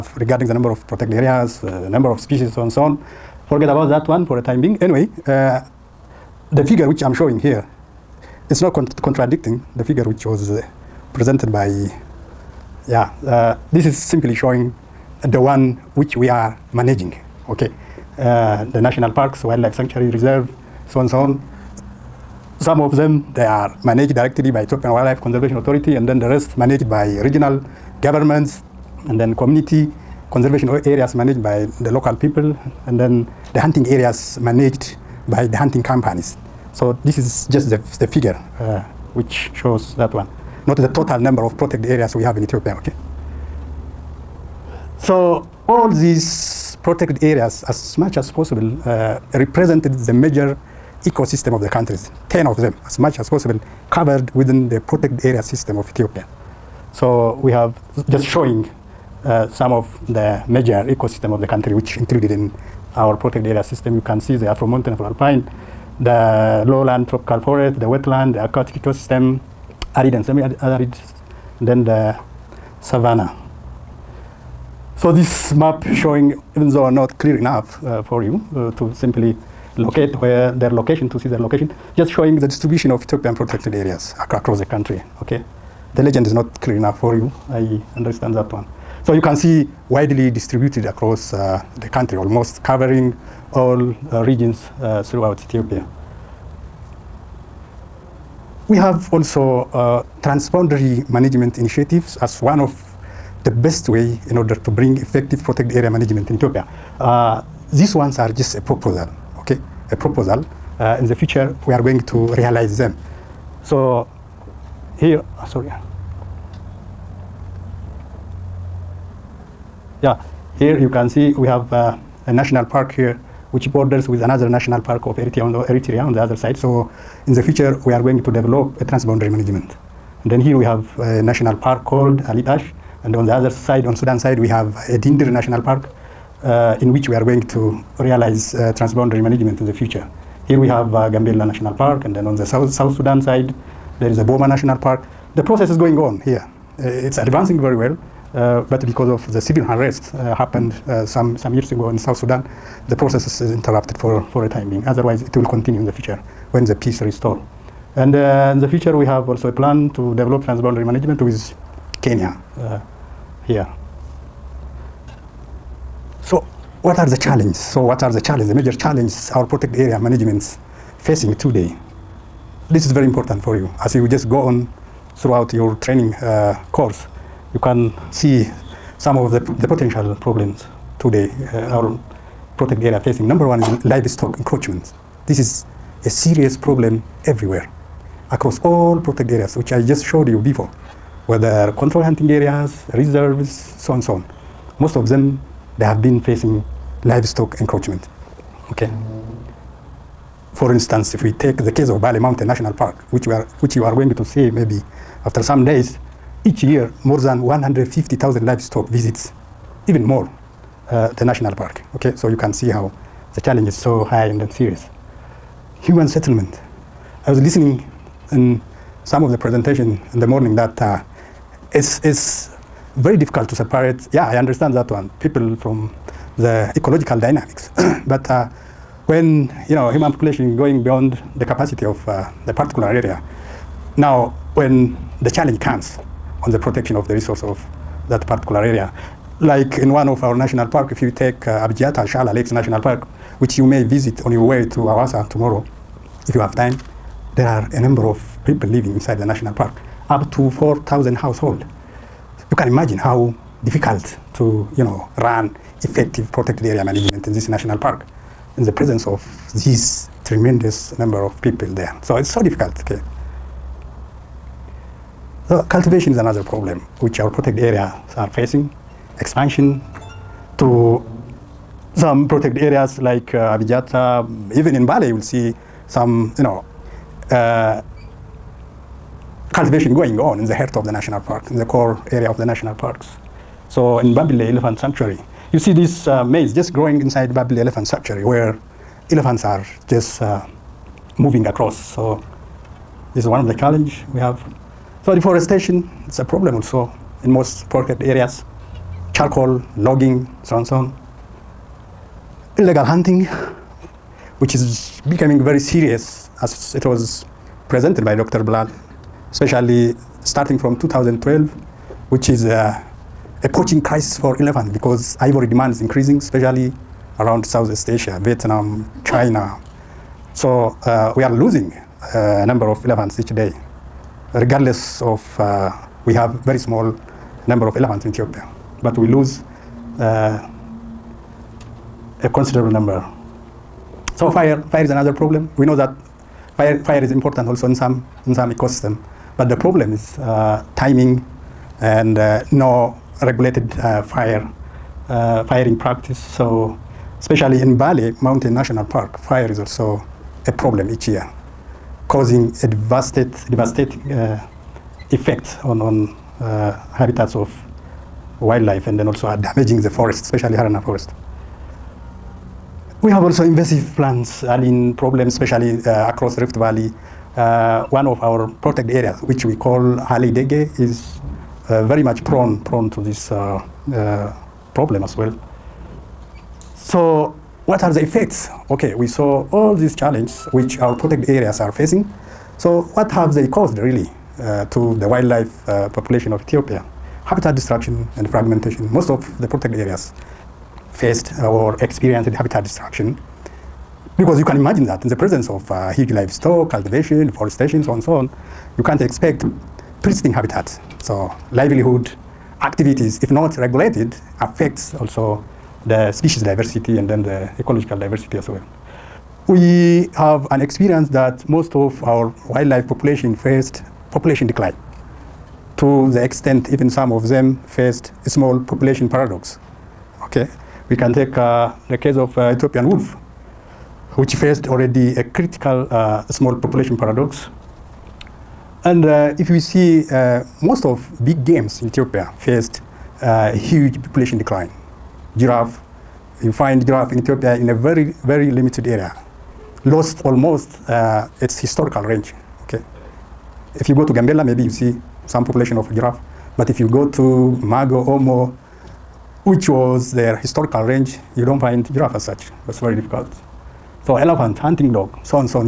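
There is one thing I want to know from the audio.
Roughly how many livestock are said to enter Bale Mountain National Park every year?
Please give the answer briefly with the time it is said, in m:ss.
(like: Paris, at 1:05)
150,000, at 3:27.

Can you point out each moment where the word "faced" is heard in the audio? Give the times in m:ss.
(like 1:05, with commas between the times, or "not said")
6:30, 6:53, 6:57, 7:04, 7:12.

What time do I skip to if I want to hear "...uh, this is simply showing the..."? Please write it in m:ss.
0:13.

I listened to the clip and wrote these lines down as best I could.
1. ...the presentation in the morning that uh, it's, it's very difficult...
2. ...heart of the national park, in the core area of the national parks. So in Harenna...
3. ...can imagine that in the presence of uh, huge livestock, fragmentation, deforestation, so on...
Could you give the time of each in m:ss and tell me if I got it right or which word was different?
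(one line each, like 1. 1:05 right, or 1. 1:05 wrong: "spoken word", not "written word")
1. 3:39 right
2. 4:40 wrong: "Babile", not "Harenna"
3. 6:34 wrong: "cultivation", not "fragmentation".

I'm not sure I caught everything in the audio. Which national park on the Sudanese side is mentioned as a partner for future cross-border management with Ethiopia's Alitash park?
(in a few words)
Dindir National Park.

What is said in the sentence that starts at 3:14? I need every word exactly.
Most of them, they have been facing livestock encroachment.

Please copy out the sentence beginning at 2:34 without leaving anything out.
Otherwise, it will continue in the future when the peace restored.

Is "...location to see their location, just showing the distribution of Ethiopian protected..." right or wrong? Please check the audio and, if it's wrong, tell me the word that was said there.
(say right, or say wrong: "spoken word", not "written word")
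right.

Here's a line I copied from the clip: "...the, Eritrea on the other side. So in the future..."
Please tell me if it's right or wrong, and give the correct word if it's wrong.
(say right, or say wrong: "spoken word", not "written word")
right.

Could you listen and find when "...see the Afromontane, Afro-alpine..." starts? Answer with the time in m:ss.
1:04.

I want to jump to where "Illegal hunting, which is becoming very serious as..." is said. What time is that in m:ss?
5:02.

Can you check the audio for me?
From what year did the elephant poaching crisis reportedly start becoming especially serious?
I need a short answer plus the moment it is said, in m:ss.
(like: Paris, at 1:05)
2012, at 5:10.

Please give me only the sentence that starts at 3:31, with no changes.
Okay, so you can see how the challenge is so high and serious.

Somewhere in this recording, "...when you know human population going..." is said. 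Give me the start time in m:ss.
3:49.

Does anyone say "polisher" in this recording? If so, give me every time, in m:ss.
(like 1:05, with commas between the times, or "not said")
not said.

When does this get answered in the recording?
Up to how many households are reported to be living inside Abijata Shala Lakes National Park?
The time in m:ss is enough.
4:10.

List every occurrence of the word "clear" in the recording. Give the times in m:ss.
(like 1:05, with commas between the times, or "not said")
1:17, 1:26.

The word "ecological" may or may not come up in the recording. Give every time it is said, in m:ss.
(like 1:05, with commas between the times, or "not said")
3:46, 6:47.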